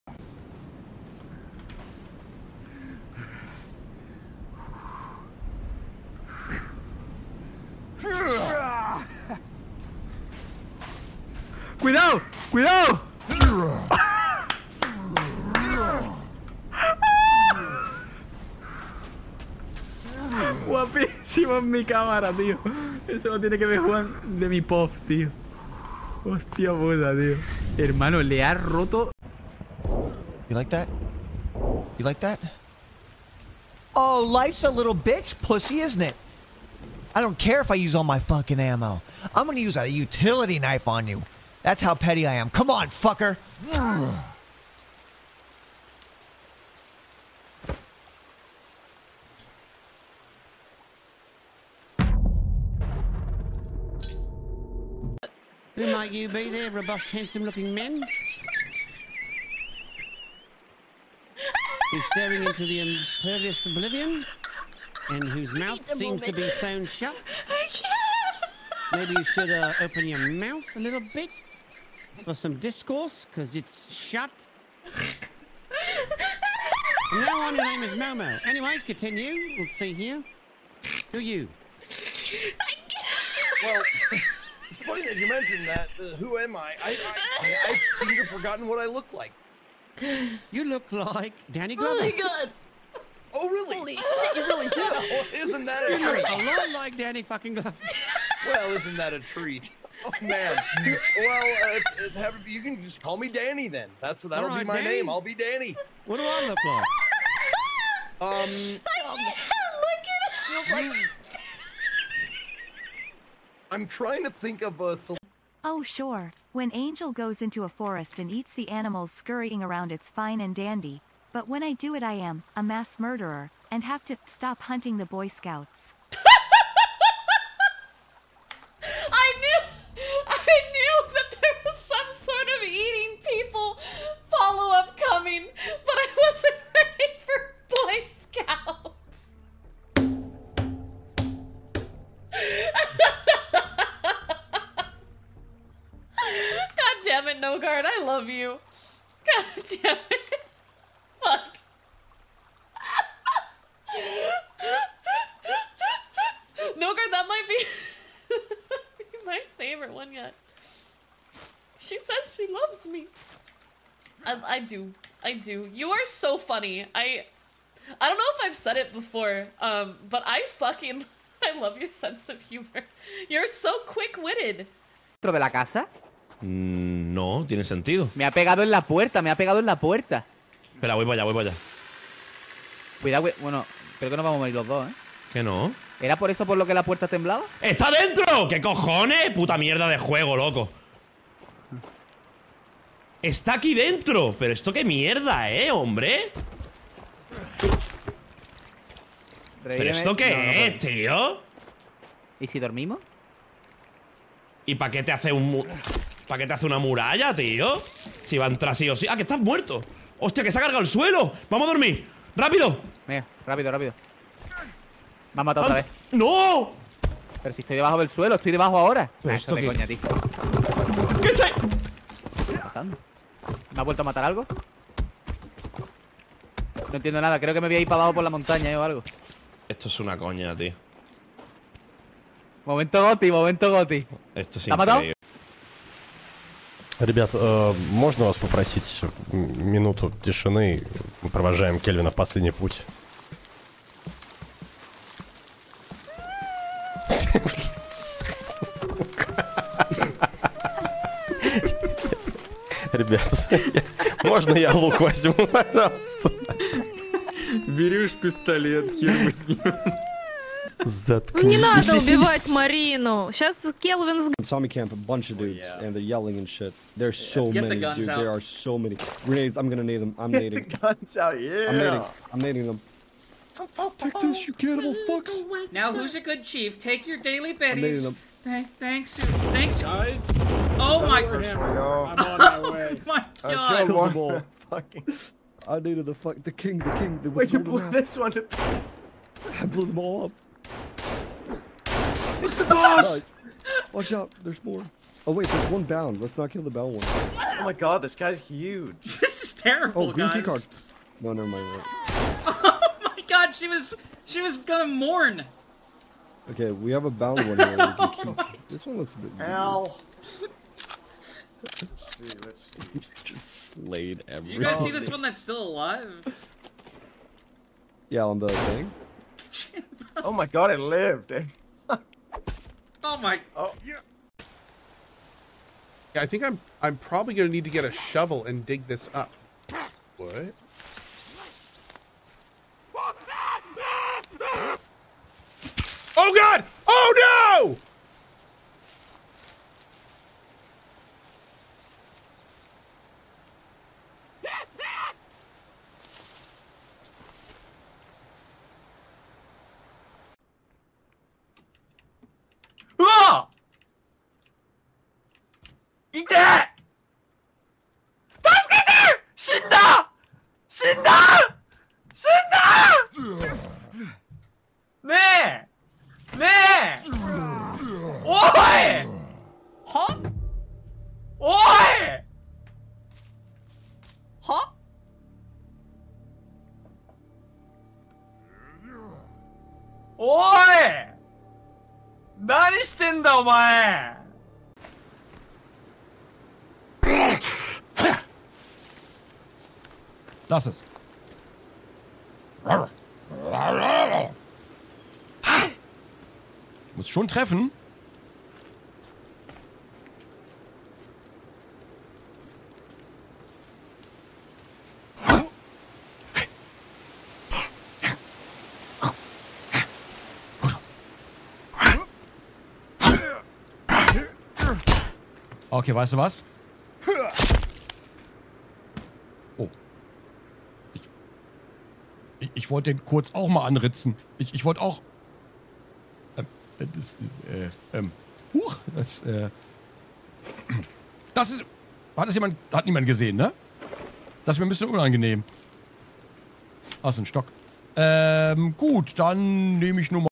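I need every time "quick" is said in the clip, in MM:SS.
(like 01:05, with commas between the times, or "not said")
02:53.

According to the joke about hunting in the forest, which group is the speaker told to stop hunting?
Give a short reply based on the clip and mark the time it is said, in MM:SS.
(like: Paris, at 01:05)
Boy Scouts, at 02:05.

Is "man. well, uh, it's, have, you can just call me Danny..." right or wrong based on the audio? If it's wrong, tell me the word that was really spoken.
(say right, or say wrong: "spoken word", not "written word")
right.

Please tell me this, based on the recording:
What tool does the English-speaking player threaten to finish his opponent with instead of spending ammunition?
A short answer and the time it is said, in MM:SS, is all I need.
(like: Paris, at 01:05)
utility knife, at 00:39.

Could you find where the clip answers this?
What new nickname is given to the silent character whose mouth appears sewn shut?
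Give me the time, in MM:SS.
01:17.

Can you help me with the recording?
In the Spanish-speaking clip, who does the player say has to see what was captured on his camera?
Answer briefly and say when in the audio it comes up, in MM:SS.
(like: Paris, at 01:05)
Juan, at 00:23.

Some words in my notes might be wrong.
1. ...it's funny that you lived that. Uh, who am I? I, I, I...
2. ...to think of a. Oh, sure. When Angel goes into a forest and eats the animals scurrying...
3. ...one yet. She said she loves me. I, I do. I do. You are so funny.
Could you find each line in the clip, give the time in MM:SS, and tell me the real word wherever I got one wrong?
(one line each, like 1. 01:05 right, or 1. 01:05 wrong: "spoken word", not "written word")
1. 01:24 wrong: "mentioned", not "lived"
2. 01:54 right
3. 02:39 right.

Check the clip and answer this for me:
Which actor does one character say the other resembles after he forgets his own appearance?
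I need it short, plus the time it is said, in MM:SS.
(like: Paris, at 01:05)
Danny Glover, at 01:31.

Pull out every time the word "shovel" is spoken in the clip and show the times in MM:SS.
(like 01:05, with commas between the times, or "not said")
05:27.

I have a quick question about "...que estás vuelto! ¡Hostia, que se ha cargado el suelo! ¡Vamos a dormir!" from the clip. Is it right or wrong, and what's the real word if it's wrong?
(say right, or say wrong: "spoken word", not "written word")
wrong: "muerto", not "vuelto".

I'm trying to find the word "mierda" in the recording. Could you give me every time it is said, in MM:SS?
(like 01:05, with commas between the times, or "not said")
03:09, 03:14.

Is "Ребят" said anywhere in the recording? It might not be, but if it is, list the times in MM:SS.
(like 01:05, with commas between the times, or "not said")
03:57, 04:12.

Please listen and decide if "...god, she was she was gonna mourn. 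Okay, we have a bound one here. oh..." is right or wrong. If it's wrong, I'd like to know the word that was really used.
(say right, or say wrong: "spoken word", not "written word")
right.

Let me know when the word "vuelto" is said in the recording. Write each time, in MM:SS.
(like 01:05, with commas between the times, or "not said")
03:43.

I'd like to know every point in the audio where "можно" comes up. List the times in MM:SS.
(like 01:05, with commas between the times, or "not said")
03:57, 04:14.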